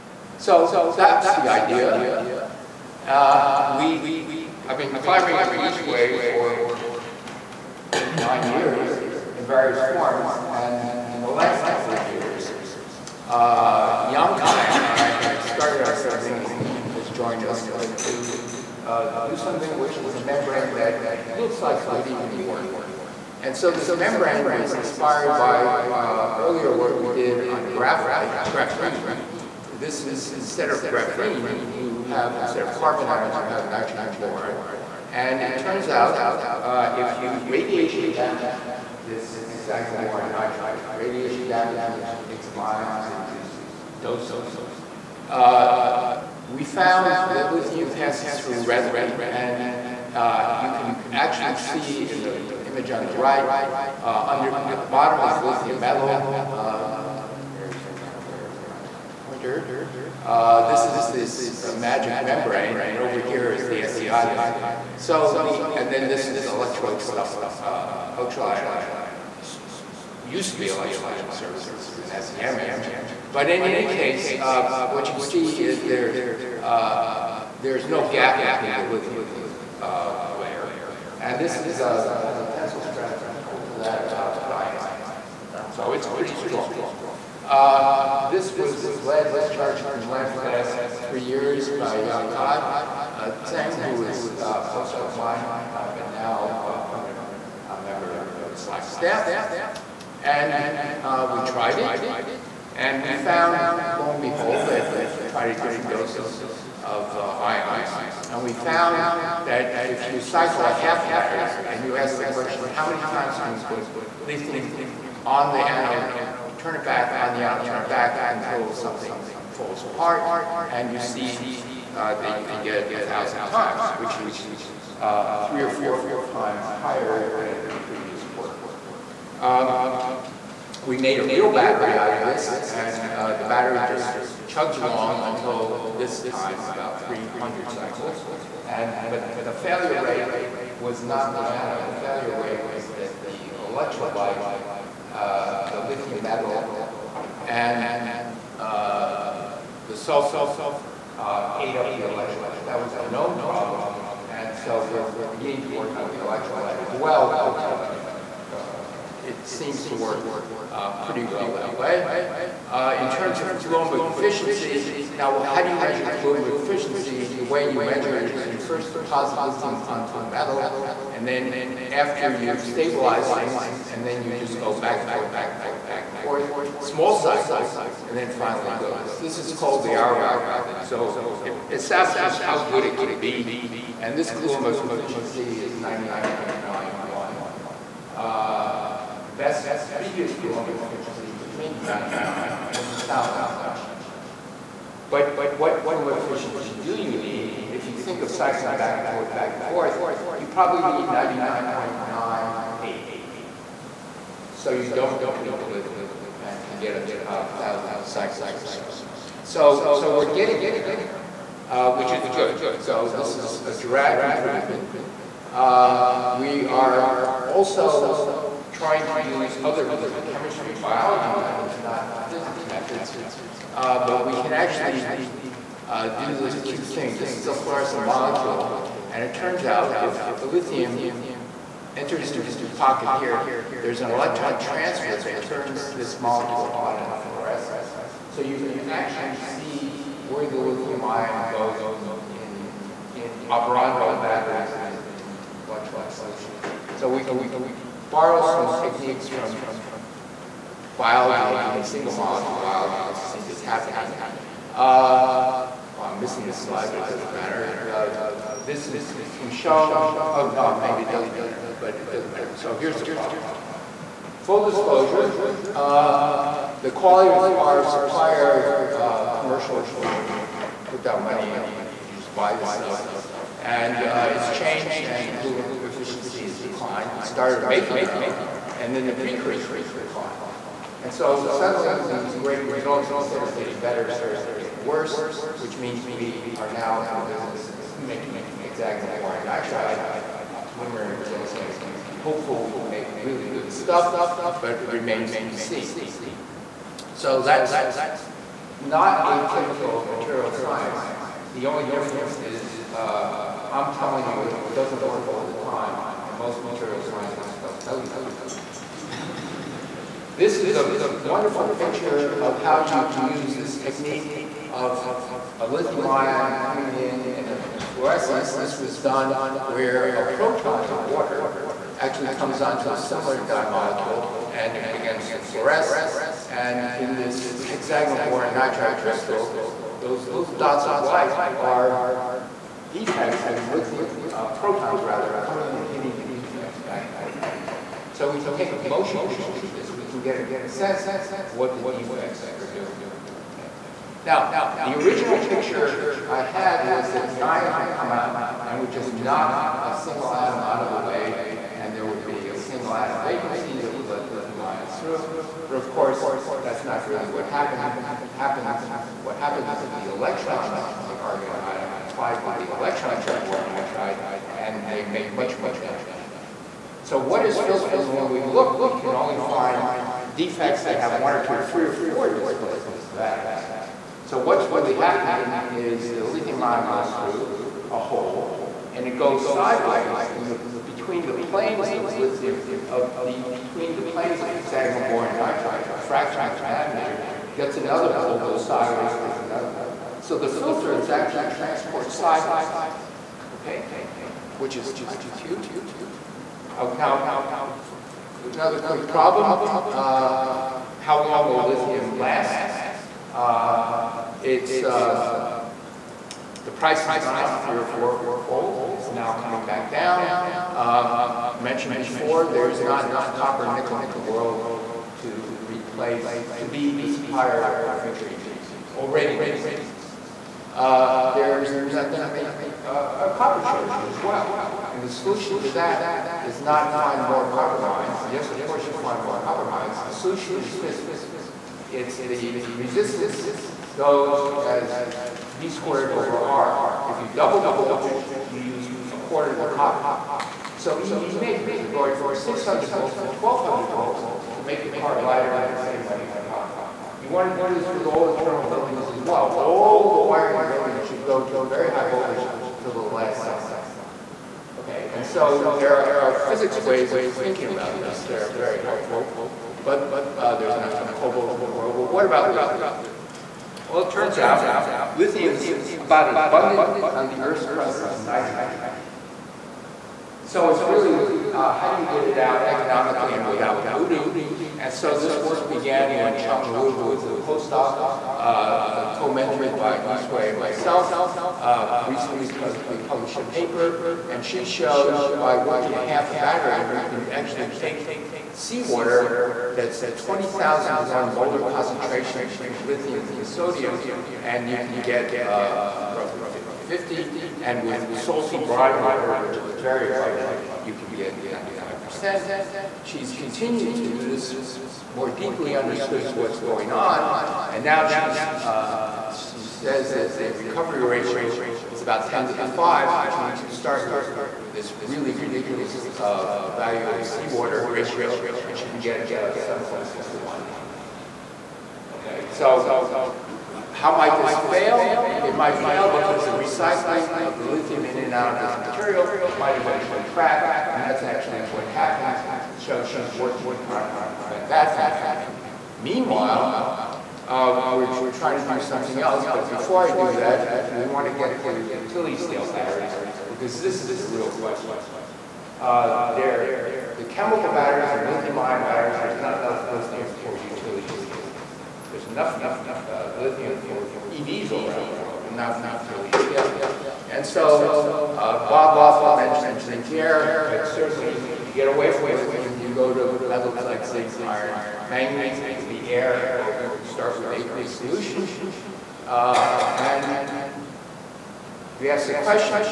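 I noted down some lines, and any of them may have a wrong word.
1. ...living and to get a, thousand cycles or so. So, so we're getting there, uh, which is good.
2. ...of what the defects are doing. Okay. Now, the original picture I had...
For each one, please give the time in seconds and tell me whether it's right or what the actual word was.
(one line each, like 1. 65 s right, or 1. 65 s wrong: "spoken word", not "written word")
1. 205 s right
2. 341 s right.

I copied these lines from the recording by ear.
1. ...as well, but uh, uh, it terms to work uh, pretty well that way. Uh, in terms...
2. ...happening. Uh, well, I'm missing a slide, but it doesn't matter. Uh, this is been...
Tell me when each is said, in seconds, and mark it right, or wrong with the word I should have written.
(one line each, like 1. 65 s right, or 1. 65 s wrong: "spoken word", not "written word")
1. 156 s wrong: "seems", not "terms"
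2. 253 s right.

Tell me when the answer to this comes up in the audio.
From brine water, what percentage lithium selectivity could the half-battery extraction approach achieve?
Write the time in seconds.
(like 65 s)
501 s.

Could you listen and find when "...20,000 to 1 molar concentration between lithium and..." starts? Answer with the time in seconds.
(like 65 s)
490 s.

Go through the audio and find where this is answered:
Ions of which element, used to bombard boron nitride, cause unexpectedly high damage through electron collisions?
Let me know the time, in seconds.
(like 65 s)
361 s.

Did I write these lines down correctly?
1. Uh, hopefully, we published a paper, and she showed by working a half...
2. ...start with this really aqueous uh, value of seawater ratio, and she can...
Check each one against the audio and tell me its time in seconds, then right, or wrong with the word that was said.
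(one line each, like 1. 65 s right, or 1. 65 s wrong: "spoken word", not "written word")
1. 481 s wrong: "recently", not "hopefully"
2. 513 s wrong: "ridiculous", not "aqueous".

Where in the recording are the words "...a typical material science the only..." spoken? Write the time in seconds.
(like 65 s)
299 s.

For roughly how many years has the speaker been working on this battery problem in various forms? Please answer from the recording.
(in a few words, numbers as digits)
9.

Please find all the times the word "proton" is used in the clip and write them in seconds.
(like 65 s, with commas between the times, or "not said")
320 s, 334 s.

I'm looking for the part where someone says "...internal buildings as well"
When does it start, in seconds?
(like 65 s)
448 s.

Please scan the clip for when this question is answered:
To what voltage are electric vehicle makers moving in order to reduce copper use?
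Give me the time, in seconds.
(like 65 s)
443 s.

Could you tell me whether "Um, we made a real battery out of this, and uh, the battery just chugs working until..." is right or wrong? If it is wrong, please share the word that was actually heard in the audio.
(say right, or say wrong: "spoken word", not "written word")
wrong: "along", not "working".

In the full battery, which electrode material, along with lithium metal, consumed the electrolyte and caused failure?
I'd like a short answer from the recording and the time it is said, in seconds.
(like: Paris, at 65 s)
sulfur, at 149 s.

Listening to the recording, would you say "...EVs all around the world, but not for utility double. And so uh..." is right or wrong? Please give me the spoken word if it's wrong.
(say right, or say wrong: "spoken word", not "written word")
wrong: "scale", not "double".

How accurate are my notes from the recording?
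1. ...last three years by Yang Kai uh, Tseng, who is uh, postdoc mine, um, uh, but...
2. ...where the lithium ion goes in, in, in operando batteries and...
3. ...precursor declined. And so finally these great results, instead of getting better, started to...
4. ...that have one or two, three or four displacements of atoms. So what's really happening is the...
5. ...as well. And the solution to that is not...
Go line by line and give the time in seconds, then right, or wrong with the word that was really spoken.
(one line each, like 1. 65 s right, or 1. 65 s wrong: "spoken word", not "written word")
1. 90 s right
2. 240 s right
3. 279 s wrong: "suddenly", not "finally"
4. 370 s right
5. 424 s right.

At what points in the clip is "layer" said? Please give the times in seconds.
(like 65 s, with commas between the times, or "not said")
64 s, 80 s.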